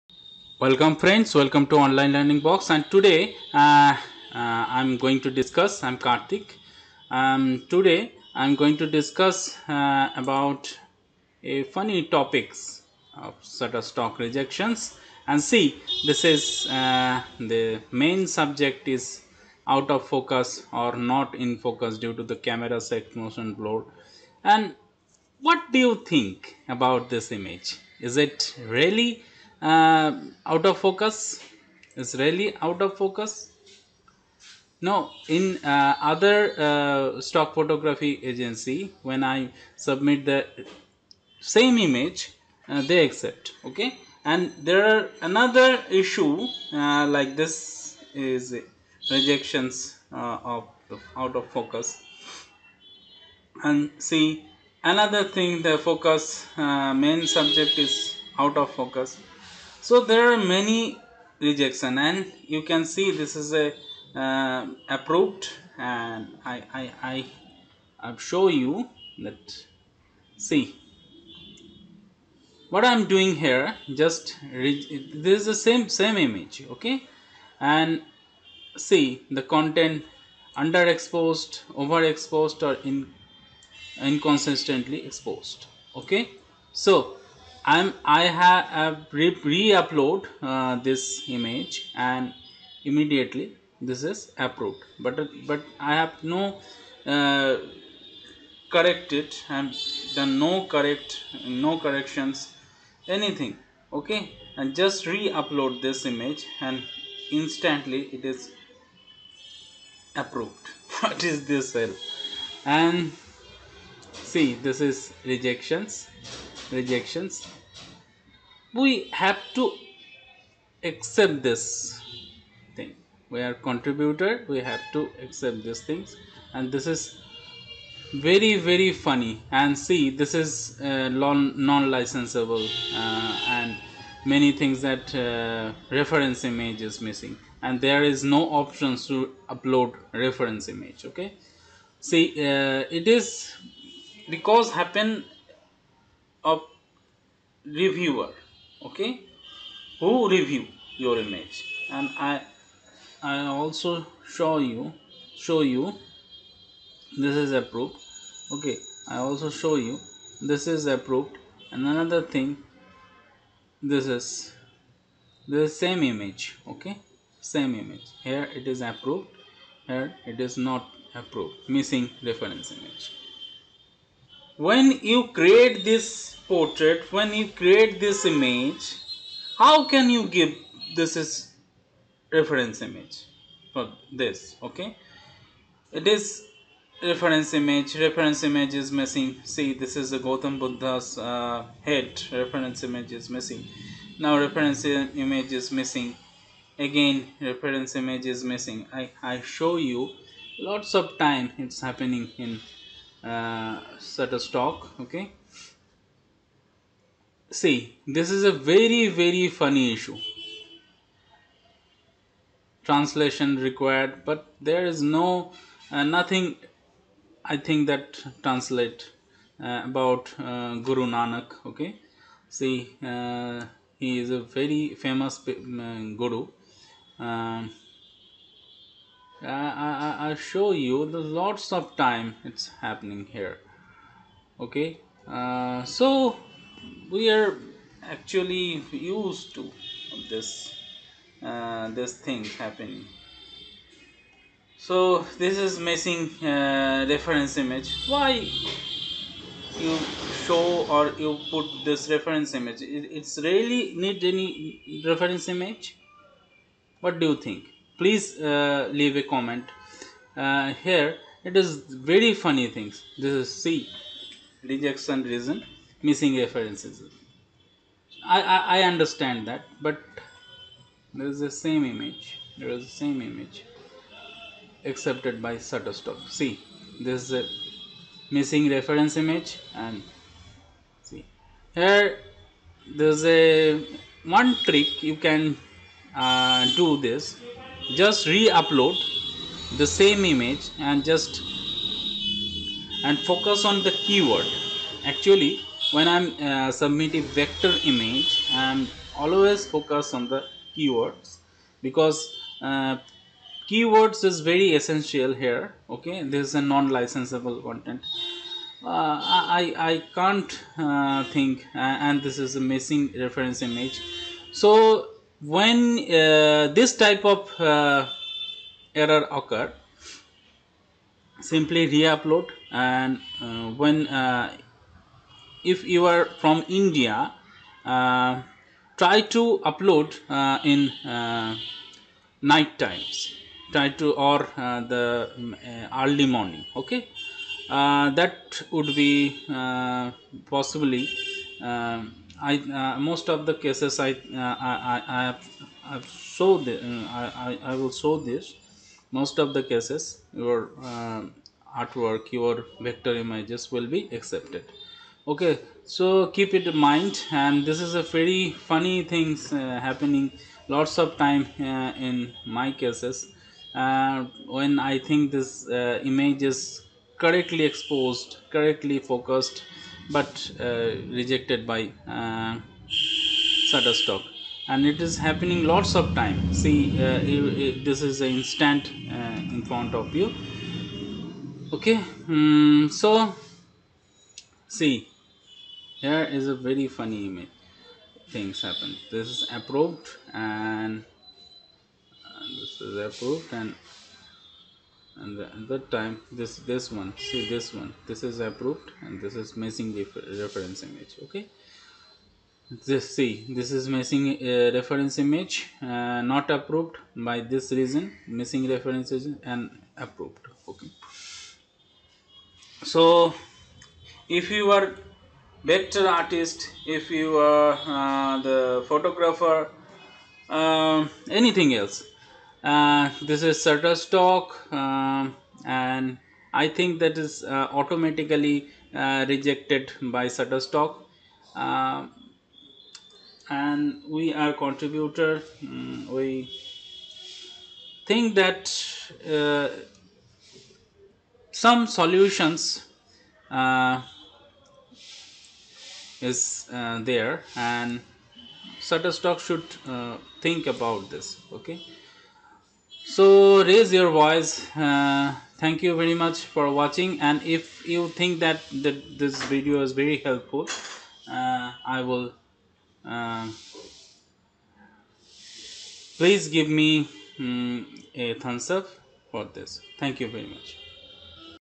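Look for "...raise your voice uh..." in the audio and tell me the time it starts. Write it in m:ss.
7:33.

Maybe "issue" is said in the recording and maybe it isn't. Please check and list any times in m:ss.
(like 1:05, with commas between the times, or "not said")
0:45, 3:29.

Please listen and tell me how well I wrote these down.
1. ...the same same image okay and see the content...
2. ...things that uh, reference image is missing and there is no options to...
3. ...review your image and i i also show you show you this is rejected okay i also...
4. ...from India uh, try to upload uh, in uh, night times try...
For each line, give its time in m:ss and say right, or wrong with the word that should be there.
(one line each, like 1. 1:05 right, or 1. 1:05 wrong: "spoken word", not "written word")
1. 1:15 right
2. 2:14 right
3. 2:30 wrong: "approved", not "rejected"
4. 5:26 right.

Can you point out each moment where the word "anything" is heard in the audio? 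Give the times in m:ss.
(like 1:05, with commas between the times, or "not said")
1:43, 7:01.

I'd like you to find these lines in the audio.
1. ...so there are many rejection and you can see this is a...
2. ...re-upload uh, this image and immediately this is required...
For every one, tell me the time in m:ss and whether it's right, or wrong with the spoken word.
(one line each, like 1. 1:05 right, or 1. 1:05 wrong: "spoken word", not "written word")
1. 0:59 right
2. 1:29 wrong: "approved", not "required".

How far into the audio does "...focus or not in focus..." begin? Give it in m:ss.
0:20.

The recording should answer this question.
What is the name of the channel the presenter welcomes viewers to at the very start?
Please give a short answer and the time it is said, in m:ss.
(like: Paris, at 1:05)
Online Learning Box, at 0:01.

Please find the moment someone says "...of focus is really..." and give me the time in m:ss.
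0:30.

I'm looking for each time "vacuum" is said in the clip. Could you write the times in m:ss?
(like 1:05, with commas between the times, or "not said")
not said.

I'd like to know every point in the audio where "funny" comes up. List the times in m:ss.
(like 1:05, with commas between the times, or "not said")
0:11, 2:08, 3:29, 4:22, 5:58, 6:26.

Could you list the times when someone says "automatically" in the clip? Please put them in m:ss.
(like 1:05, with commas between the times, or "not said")
7:07.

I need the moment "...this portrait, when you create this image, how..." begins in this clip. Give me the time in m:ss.
2:55.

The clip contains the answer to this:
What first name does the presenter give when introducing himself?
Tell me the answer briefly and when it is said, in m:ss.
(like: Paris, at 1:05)
Kartik, at 0:05.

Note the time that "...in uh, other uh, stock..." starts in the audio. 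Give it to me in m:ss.
0:35.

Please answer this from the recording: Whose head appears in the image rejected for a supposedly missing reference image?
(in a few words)
Gautam Buddha.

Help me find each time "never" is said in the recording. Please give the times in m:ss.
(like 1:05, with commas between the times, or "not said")
not said.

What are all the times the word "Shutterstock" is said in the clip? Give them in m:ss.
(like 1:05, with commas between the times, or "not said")
0:13, 4:35, 6:12, 7:03, 7:10, 7:28.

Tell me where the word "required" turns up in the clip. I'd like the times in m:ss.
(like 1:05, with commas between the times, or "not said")
3:33.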